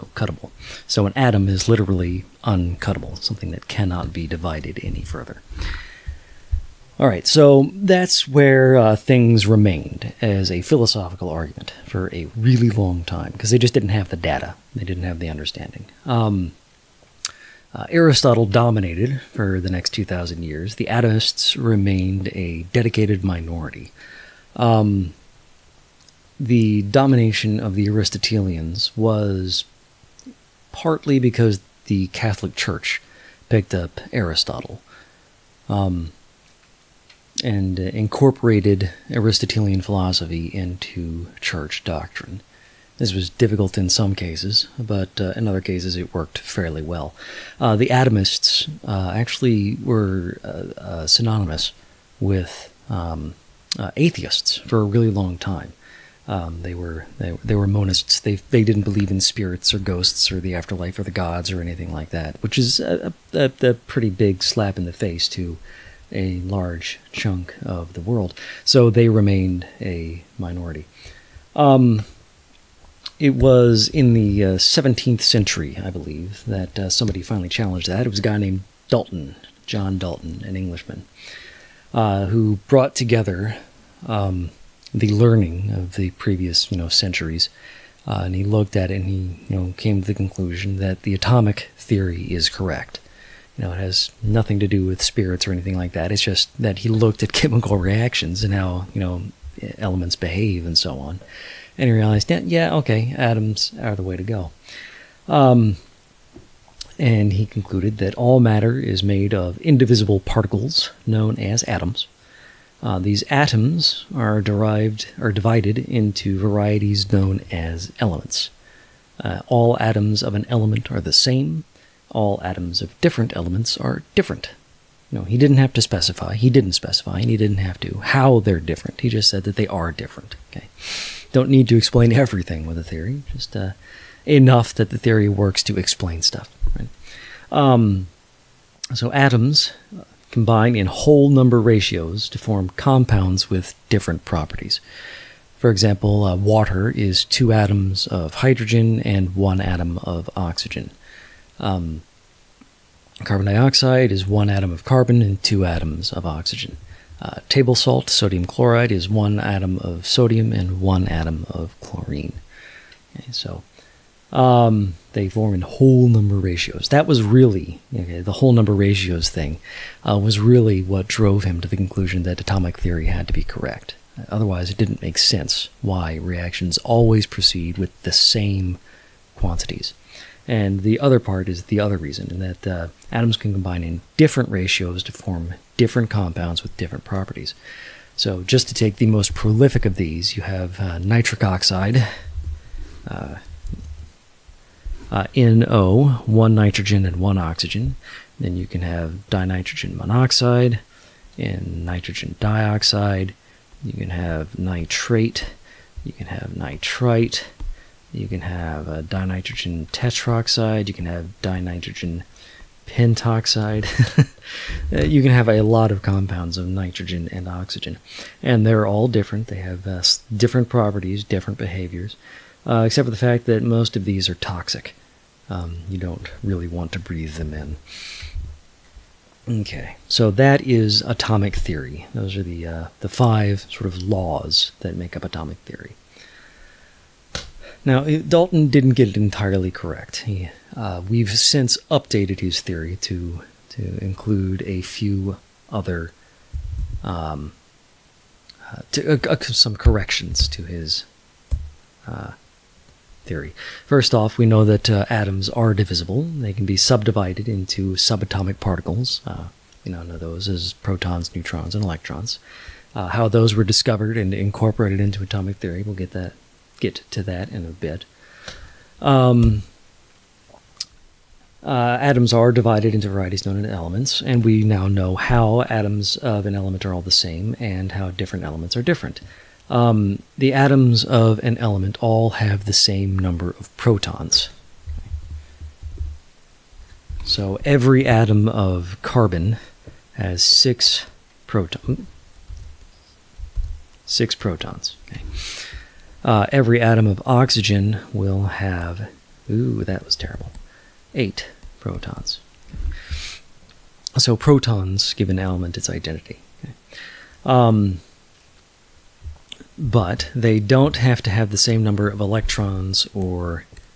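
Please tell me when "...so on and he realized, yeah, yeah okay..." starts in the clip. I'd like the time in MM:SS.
01:40.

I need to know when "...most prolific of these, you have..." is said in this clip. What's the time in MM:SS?
03:09.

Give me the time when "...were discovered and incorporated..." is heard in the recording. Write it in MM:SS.
04:23.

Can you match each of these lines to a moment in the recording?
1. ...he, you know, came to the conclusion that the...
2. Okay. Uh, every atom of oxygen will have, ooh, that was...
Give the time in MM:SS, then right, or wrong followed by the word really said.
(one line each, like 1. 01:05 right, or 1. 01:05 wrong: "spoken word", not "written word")
1. 01:29 right
2. 04:55 right.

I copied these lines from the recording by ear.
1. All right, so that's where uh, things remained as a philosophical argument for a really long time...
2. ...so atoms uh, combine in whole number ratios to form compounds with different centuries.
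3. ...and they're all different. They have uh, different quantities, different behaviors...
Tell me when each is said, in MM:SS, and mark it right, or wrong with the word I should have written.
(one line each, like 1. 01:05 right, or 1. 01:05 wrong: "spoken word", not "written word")
1. 00:06 right
2. 02:18 wrong: "properties", not "centuries"
3. 03:38 wrong: "properties", not "quantities".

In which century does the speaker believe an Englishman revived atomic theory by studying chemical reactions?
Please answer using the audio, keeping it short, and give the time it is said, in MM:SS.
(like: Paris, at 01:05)
17th century, at 01:14.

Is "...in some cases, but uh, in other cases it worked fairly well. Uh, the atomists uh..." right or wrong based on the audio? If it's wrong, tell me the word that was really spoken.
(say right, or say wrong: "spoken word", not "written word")
right.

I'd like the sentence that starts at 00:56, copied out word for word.
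Um, they were they, they were monists.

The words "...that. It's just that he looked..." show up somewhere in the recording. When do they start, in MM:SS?
01:35.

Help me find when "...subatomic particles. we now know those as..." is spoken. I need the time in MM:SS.
04:17.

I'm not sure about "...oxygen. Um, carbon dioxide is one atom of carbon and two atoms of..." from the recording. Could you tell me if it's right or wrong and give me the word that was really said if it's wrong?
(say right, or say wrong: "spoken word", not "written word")
right.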